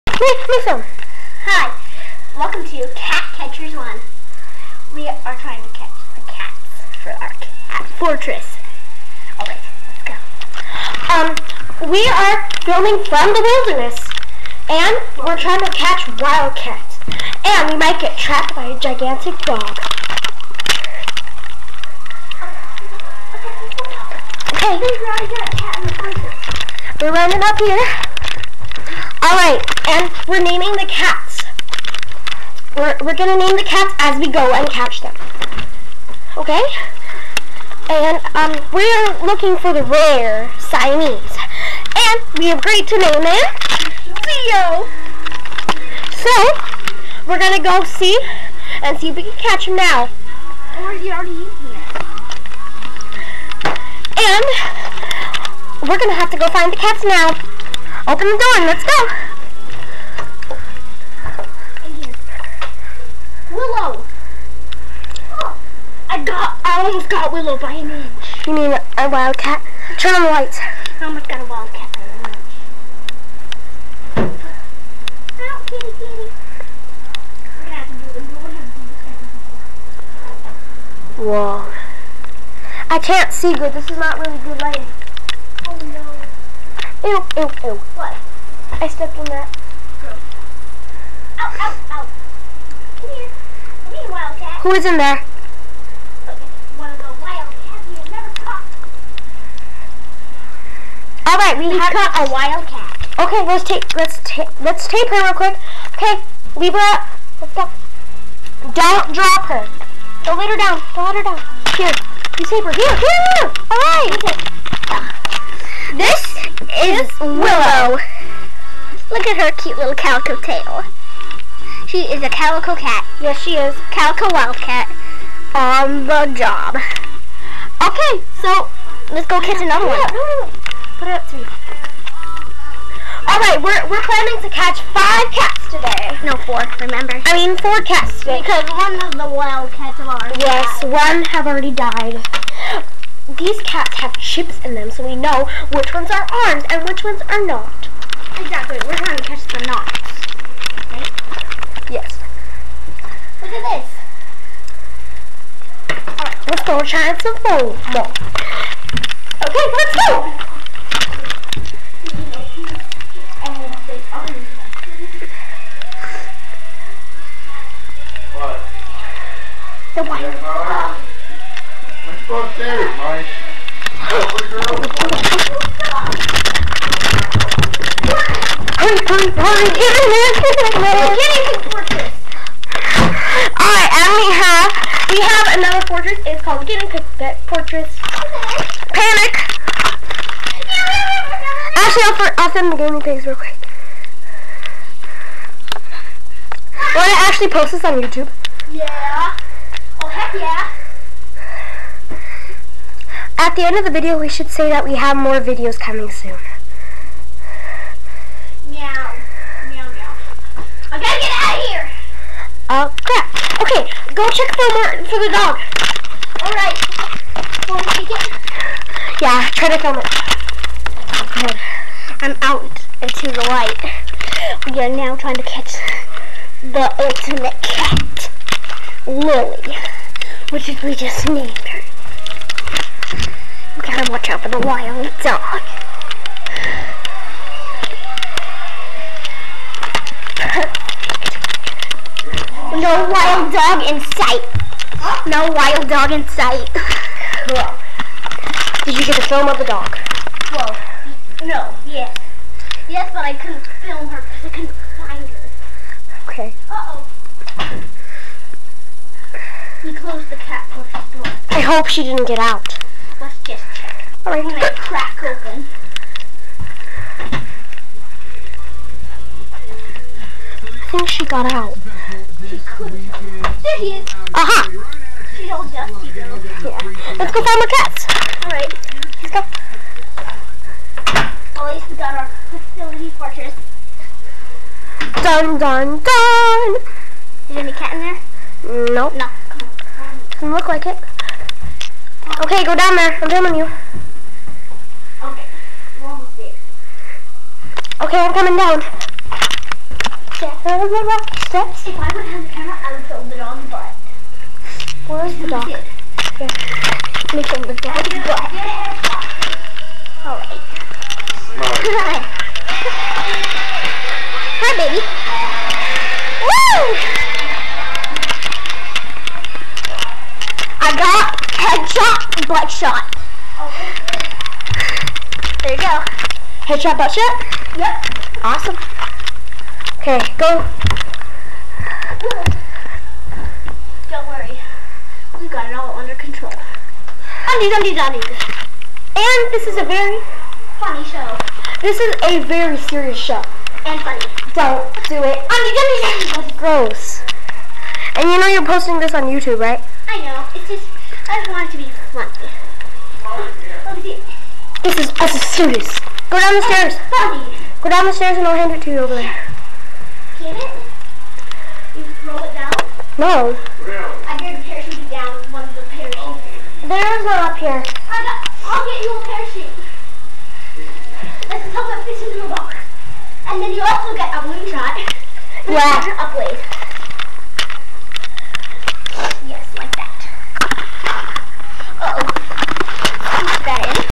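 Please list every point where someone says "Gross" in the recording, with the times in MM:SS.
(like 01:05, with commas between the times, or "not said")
01:30, 05:46.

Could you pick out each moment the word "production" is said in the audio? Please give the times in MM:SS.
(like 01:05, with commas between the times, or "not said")
not said.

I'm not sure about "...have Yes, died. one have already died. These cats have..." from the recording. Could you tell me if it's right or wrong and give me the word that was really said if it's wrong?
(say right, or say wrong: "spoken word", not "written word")
right.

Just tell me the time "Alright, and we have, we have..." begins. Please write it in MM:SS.
03:03.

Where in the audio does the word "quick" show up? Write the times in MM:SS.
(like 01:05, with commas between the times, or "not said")
01:45, 03:13.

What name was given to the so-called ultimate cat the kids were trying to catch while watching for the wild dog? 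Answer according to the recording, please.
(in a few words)
Lily.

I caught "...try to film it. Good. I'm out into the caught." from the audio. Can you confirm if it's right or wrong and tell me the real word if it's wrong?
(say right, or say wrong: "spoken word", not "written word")
wrong: "light", not "caught".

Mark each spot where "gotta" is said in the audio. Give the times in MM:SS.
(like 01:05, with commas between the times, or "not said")
03:31.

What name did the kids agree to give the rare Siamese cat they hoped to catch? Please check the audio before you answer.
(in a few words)
Leo.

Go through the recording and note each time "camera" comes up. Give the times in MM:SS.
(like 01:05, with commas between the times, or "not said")
05:02.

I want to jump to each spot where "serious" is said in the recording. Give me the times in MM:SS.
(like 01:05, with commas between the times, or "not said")
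05:42, 05:55.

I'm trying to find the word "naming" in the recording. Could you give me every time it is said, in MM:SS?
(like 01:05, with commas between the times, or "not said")
00:30.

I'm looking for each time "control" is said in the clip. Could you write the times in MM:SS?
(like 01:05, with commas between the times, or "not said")
05:36.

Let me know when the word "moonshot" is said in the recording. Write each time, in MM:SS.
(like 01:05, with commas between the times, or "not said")
06:14.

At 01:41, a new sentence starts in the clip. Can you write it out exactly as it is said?
All right, we, we have caught a wildcat.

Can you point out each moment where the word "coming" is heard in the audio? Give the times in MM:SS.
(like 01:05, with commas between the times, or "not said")
03:25, 04:58.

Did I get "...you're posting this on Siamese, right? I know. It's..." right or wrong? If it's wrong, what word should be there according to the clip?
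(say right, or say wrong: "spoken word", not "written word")
wrong: "YouTube", not "Siamese".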